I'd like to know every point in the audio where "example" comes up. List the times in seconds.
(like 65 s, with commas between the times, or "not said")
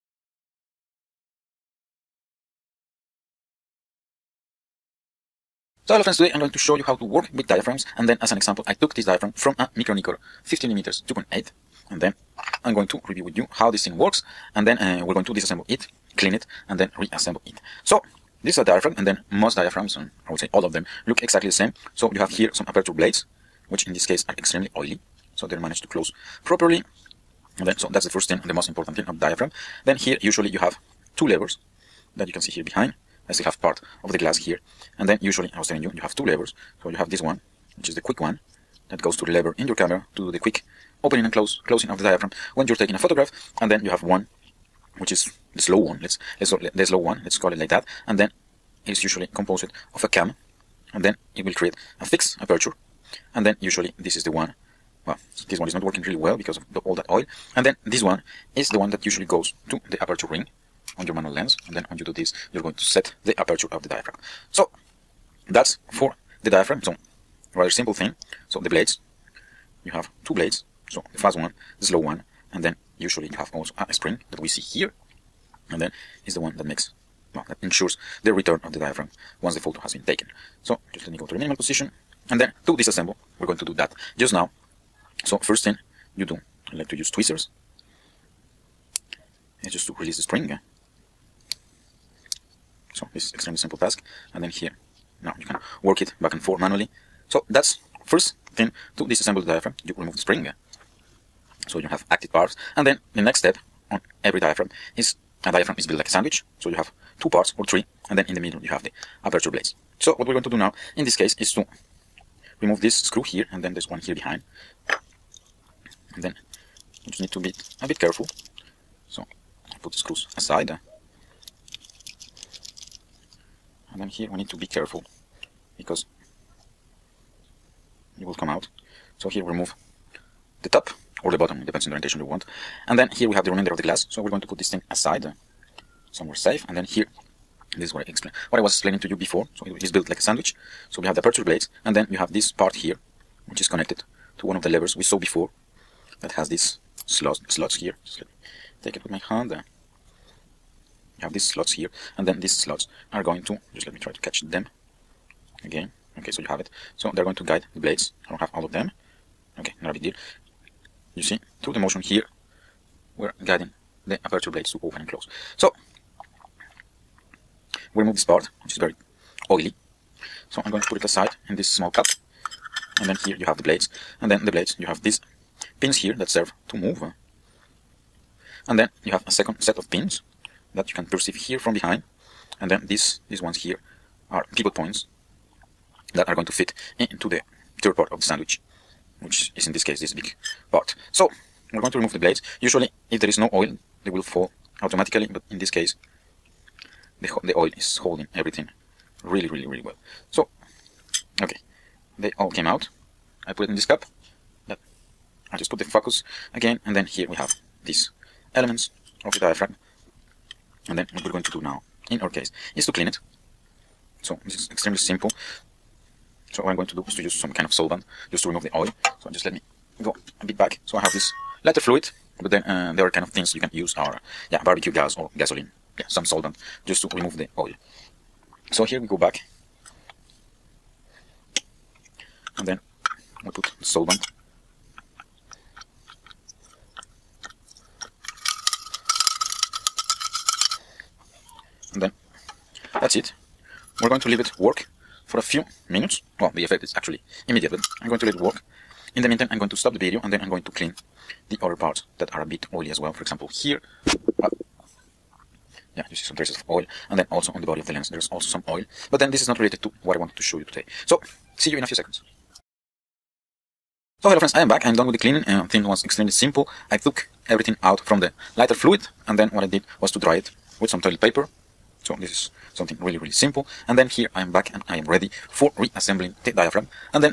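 8 s, 253 s.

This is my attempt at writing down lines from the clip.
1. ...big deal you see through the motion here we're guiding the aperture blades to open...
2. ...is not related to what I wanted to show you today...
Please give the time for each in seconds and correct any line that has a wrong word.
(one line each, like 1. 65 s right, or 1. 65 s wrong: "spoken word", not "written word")
1. 159 s right
2. 259 s right.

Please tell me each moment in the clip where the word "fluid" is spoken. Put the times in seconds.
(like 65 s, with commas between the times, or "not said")
221 s, 268 s.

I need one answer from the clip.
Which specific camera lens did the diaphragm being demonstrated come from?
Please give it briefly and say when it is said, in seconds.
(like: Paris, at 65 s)
Micro-Nikkor 50mm 2.8, at 9 s.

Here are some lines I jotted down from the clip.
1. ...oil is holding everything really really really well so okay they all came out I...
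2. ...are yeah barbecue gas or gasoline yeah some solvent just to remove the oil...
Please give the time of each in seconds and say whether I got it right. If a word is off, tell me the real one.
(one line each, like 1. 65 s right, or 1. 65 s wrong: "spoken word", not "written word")
1. 197 s right
2. 223 s right.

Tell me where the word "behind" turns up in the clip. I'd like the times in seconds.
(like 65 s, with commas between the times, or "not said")
32 s, 114 s, 181 s.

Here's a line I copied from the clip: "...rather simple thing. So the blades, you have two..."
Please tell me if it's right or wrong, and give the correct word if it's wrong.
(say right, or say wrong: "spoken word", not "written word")
right.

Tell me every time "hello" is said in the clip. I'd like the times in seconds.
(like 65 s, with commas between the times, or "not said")
5 s, 264 s.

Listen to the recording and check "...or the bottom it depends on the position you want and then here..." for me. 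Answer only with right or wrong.
wrong.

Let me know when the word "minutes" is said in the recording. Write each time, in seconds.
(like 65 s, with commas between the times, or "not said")
245 s.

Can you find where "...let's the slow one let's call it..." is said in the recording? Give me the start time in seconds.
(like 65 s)
46 s.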